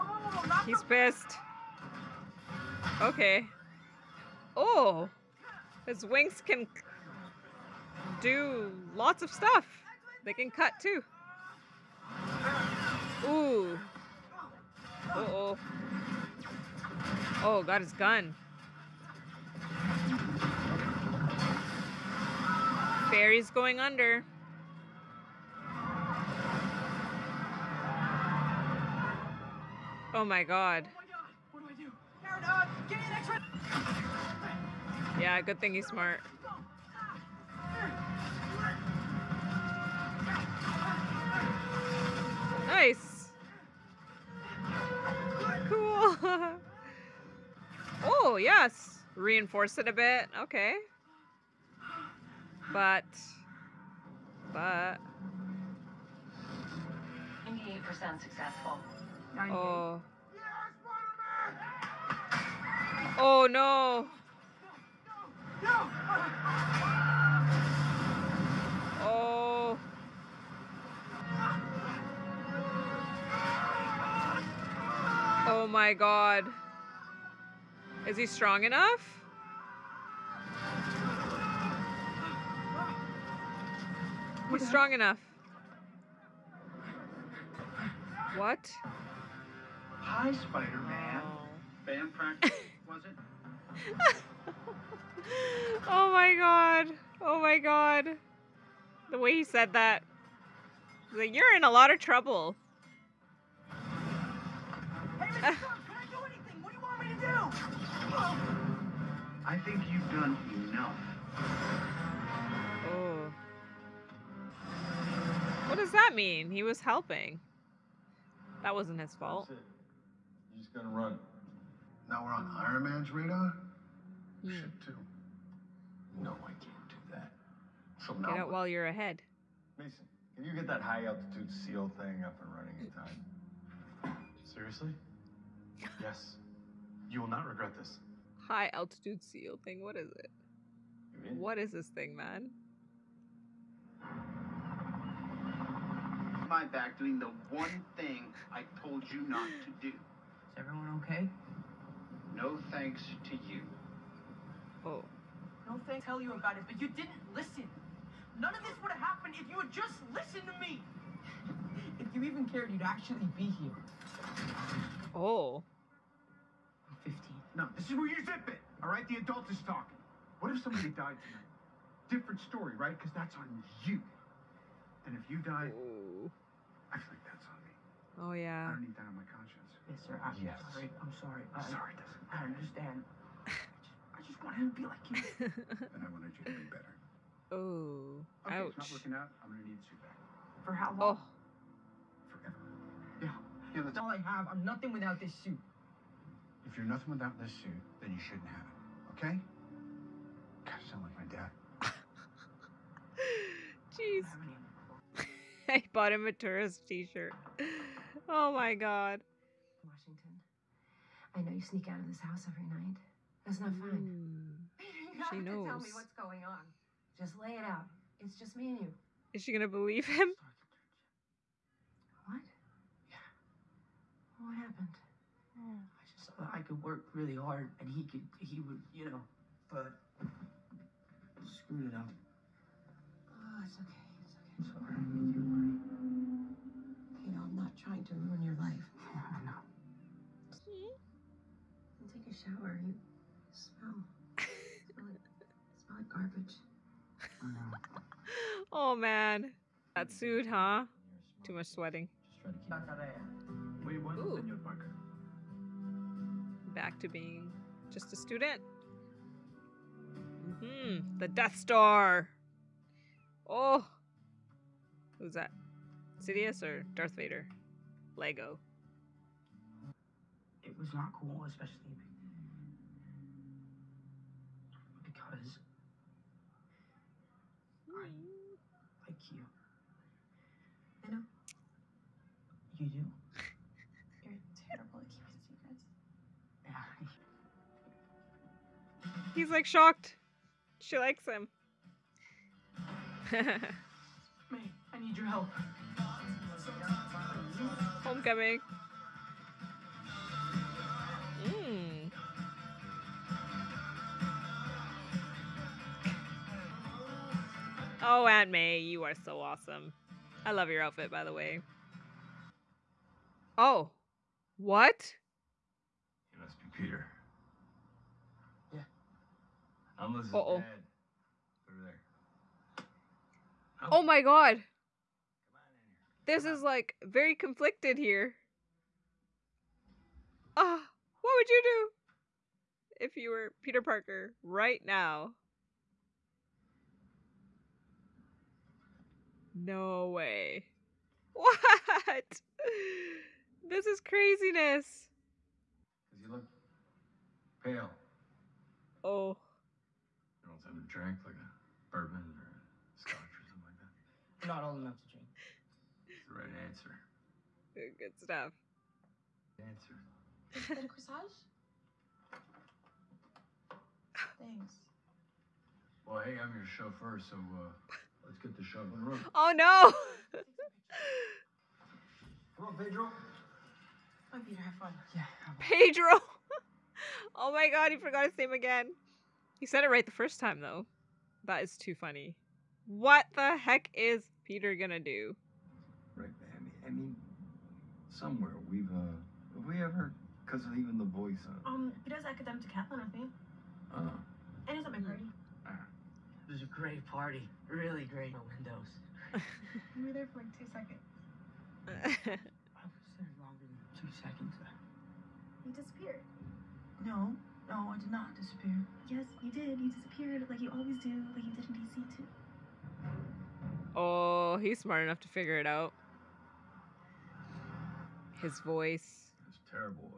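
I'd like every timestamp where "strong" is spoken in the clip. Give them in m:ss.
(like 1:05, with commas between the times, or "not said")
1:18, 1:24.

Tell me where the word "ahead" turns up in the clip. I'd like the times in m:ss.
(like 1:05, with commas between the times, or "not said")
2:08.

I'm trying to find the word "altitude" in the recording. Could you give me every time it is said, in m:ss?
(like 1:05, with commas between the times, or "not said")
2:11, 2:18.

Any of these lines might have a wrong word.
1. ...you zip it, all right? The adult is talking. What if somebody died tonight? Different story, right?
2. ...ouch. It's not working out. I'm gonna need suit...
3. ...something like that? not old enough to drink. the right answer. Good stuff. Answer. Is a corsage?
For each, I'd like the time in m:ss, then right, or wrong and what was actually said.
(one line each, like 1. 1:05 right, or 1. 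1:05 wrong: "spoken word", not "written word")
1. 2:48 right
2. 3:08 right
3. 5:53 right.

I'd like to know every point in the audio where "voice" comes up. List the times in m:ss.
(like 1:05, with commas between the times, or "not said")
6:31, 6:58.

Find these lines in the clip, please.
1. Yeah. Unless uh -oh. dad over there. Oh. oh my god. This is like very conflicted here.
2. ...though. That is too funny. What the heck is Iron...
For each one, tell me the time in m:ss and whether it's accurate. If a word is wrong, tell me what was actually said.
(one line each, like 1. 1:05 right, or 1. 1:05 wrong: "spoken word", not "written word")
1. 5:18 right
2. 6:20 wrong: "Peter", not "Iron".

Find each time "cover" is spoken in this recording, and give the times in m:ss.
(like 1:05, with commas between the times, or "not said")
not said.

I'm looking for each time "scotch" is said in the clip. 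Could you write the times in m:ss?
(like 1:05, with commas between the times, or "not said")
5:52.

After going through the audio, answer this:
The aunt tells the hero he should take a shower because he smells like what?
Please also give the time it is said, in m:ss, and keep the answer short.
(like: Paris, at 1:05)
garbage, at 4:05.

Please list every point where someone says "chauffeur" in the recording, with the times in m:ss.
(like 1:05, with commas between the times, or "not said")
6:06.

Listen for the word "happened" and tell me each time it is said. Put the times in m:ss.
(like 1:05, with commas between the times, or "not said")
2:38, 3:44.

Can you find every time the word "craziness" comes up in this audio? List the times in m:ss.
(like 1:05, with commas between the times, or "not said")
5:43.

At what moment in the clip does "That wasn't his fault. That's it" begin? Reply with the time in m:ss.
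1:58.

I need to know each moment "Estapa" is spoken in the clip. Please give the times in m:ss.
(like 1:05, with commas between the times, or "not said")
not said.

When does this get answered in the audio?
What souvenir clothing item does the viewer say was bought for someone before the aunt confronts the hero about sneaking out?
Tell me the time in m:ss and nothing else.
3:26.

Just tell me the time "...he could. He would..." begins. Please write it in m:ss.
3:47.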